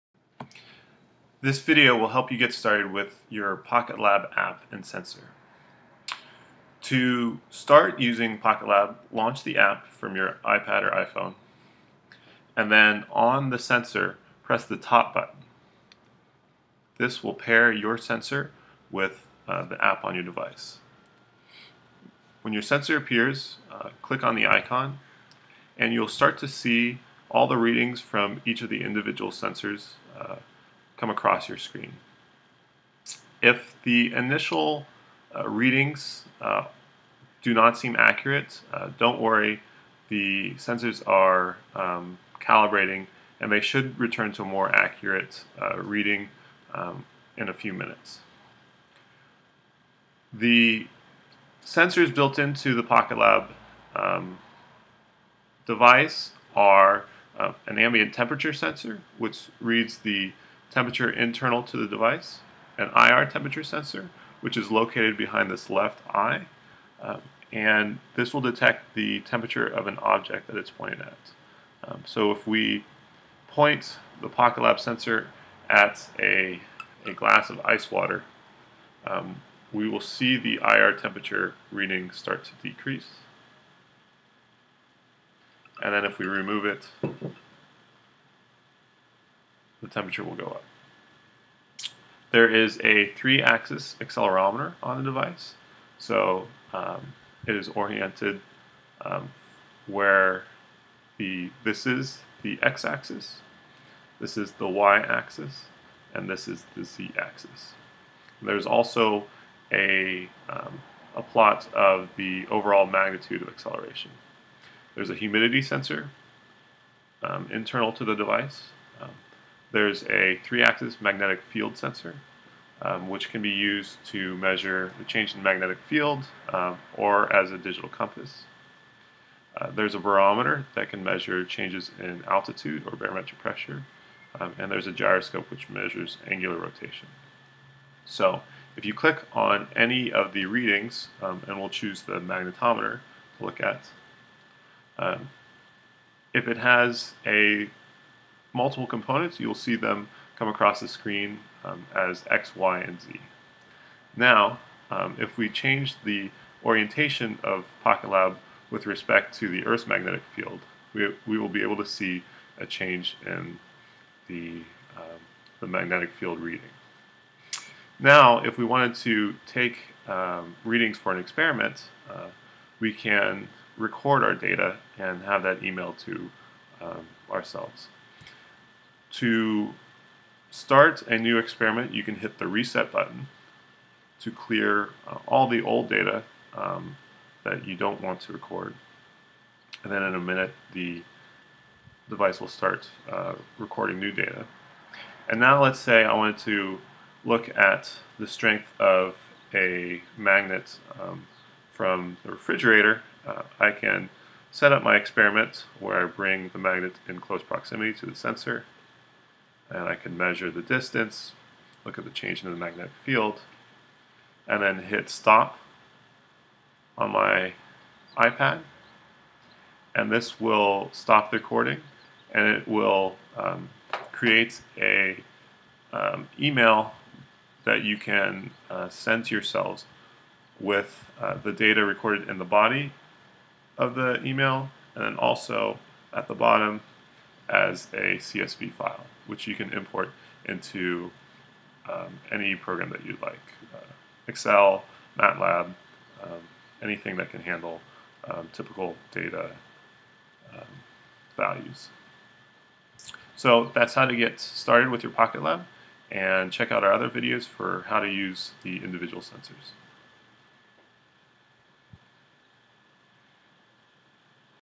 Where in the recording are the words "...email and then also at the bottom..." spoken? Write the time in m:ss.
3:54.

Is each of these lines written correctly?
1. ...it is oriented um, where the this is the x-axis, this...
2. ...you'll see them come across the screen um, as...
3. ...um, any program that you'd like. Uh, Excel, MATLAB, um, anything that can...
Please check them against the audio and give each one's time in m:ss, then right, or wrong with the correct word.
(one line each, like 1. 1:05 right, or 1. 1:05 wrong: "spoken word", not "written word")
1. 1:37 right
2. 2:29 right
3. 4:01 right.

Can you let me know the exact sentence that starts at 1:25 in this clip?
And then if we remove it, the temperature will go up.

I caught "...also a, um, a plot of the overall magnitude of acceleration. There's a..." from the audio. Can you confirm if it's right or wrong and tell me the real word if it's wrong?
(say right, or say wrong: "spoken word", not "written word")
right.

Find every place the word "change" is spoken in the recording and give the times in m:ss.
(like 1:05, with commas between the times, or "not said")
2:05, 2:11, 2:35, 2:42, 3:32.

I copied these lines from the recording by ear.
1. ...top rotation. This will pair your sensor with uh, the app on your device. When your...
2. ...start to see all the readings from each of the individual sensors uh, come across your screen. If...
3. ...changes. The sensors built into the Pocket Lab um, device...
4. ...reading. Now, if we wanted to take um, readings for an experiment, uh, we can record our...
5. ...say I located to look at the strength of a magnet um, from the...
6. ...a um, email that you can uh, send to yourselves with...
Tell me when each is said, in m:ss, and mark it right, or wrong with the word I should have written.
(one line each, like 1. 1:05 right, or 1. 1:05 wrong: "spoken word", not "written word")
1. 0:14 wrong: "button", not "rotation"
2. 0:26 right
3. 0:47 wrong: "minutes", not "changes"
4. 2:46 right
5. 3:15 wrong: "wanted", not "located"
6. 3:44 right.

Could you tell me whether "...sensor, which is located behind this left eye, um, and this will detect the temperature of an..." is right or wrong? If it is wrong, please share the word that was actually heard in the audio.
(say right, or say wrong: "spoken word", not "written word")
right.